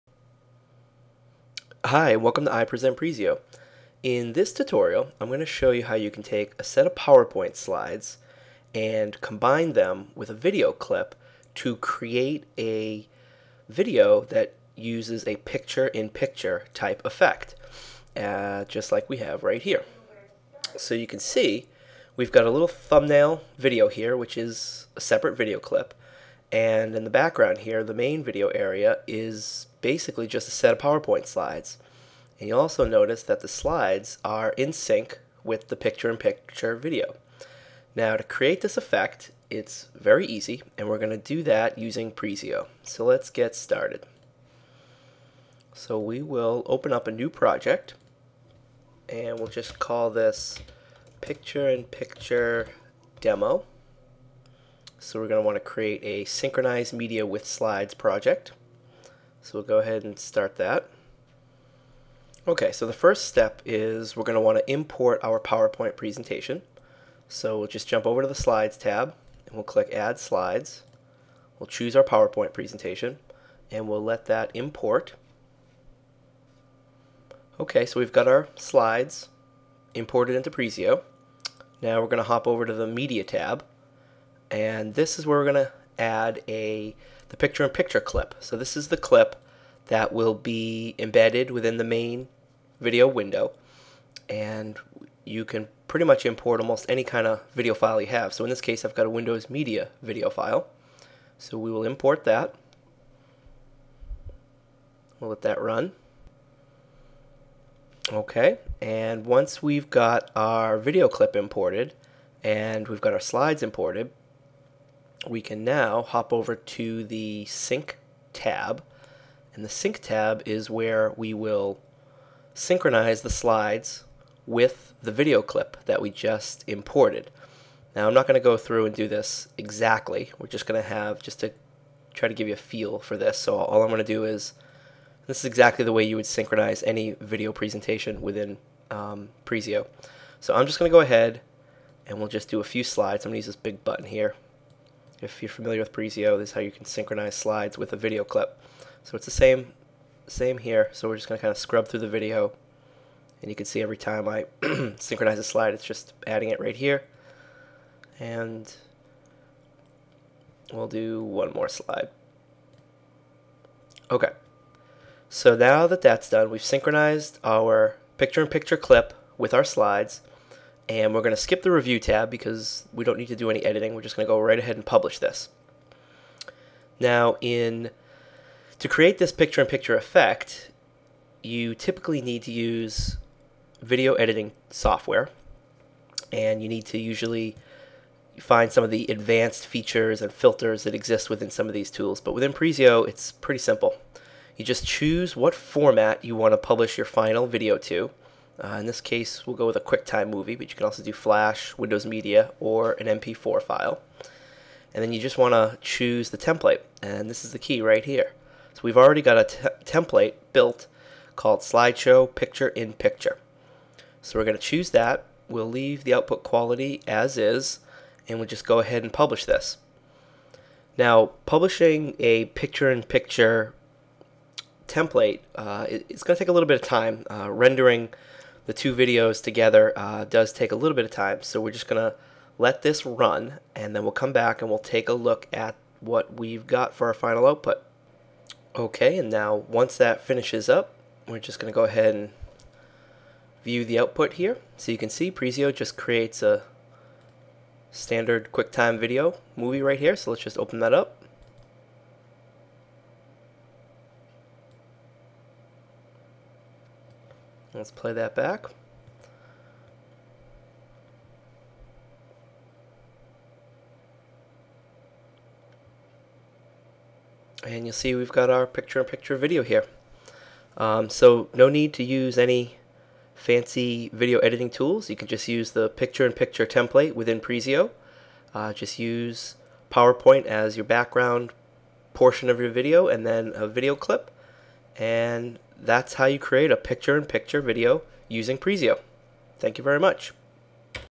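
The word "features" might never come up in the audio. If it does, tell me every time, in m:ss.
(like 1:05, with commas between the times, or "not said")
3:09.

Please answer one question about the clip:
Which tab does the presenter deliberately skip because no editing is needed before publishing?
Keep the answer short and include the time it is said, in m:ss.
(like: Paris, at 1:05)
review tab, at 2:51.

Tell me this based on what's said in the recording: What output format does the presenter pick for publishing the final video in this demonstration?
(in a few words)
QuickTime movie.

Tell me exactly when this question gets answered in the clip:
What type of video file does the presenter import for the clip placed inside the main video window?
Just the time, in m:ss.
1:39.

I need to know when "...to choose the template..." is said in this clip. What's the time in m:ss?
3:25.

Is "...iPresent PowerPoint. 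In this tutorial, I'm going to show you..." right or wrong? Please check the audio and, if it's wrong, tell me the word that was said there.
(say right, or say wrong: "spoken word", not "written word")
wrong: "Presio", not "PowerPoint".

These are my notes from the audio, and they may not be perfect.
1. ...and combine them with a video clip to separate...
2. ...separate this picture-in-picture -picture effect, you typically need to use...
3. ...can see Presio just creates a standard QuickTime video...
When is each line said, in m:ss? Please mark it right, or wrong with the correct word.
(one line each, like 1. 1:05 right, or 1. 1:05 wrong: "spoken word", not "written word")
1. 0:08 wrong: "create", not "separate"
2. 2:58 wrong: "create", not "separate"
3. 4:04 right.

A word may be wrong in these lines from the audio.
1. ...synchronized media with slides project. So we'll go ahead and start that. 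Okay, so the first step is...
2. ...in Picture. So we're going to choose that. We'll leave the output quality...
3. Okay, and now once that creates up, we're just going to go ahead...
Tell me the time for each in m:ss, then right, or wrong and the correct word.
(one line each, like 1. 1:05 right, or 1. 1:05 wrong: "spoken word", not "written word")
1. 0:56 right
2. 3:32 right
3. 3:58 wrong: "finishes", not "creates".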